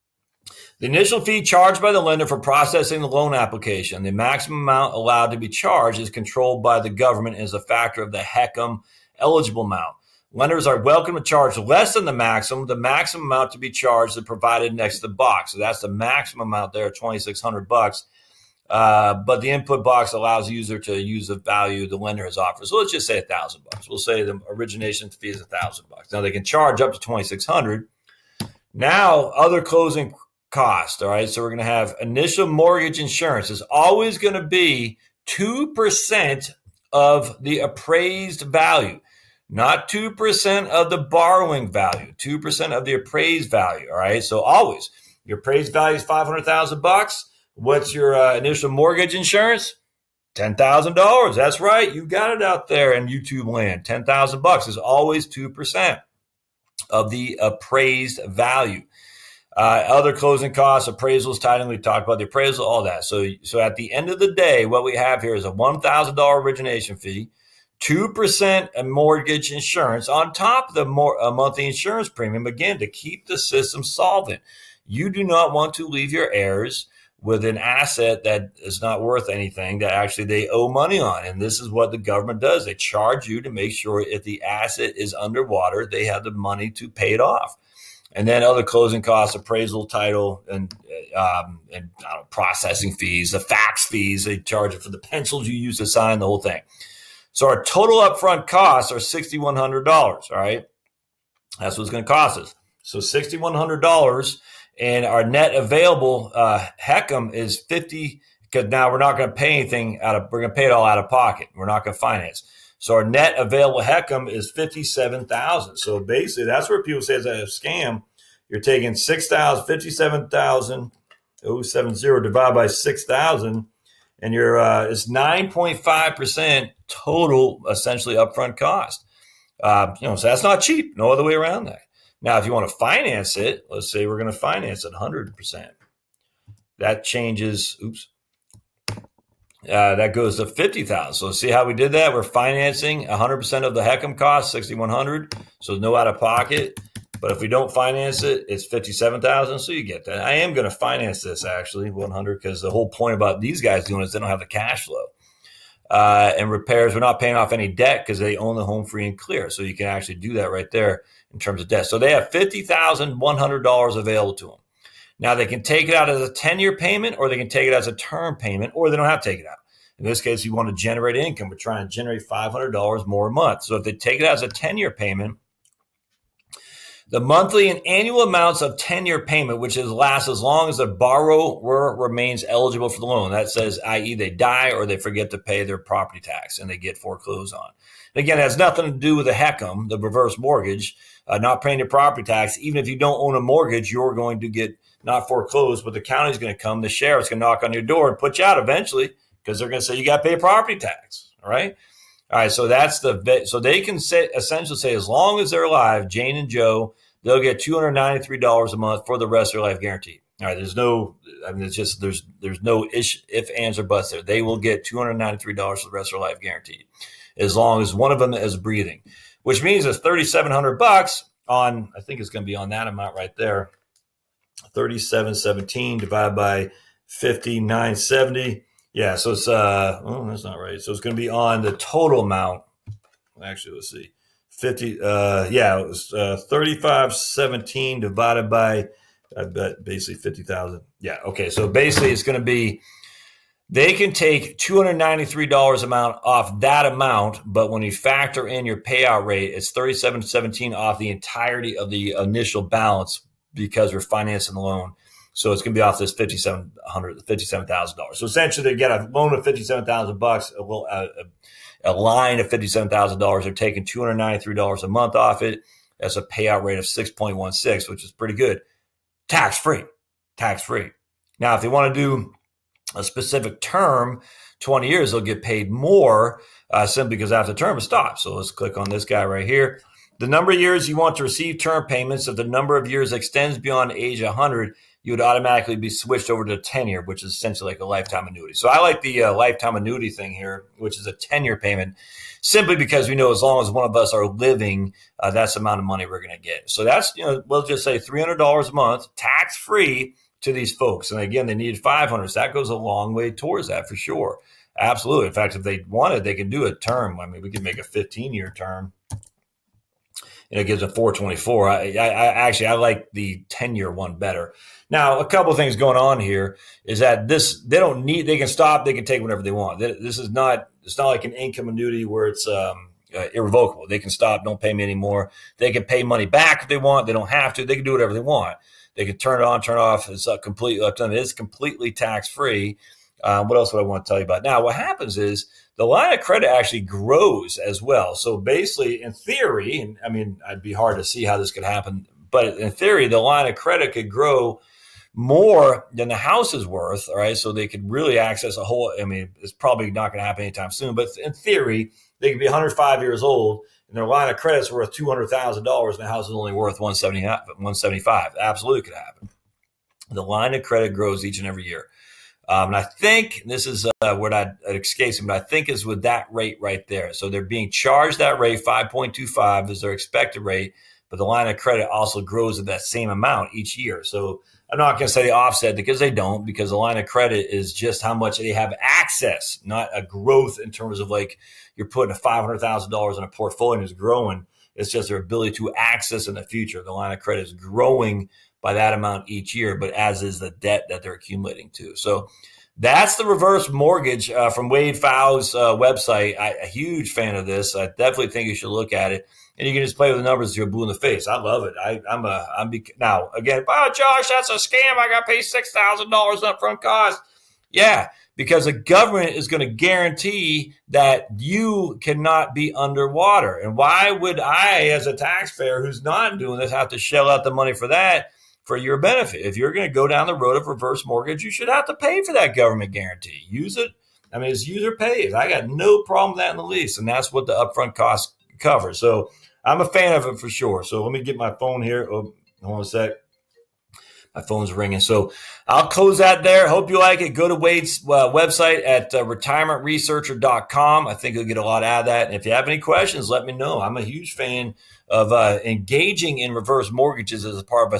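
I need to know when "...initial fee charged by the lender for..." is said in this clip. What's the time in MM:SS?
00:00.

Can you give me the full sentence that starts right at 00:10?
Lenders are welcome to charge less than the maximum.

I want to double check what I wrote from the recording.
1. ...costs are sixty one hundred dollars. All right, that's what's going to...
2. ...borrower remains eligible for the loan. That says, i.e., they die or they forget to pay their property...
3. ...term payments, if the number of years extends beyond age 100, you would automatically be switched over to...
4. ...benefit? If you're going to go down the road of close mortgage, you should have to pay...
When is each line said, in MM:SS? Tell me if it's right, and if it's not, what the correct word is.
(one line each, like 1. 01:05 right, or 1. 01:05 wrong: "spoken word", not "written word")
1. 01:38 right
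2. 03:00 right
3. 04:41 right
4. 06:58 wrong: "reverse", not "close".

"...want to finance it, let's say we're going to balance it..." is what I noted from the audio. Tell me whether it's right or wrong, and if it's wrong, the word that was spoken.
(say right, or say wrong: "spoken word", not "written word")
wrong: "finance", not "balance".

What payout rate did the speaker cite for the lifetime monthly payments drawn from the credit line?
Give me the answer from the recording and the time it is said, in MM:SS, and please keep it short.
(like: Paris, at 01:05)
6.16, at 04:26.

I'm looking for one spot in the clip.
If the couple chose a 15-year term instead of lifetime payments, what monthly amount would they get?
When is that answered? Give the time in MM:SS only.
05:10.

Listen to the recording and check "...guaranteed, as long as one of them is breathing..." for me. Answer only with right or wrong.
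right.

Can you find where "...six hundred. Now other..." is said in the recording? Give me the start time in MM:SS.
00:27.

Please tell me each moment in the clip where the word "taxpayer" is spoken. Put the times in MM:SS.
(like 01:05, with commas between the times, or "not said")
06:55.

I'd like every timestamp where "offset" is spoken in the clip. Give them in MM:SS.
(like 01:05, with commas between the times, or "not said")
06:15.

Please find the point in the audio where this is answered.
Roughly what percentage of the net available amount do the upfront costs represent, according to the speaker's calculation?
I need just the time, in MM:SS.
02:05.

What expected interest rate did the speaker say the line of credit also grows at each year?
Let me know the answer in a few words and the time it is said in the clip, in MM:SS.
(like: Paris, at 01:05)
5.25, at 06:08.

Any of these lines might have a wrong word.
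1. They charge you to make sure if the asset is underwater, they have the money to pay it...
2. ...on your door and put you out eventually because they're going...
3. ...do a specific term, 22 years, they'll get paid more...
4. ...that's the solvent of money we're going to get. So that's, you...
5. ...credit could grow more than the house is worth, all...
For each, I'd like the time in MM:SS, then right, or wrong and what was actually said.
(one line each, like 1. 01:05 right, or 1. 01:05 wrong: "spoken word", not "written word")
1. 01:22 right
2. 03:17 right
3. 04:32 wrong: "20", not "22"
4. 04:55 wrong: "amount", not "solvent"
5. 05:43 right.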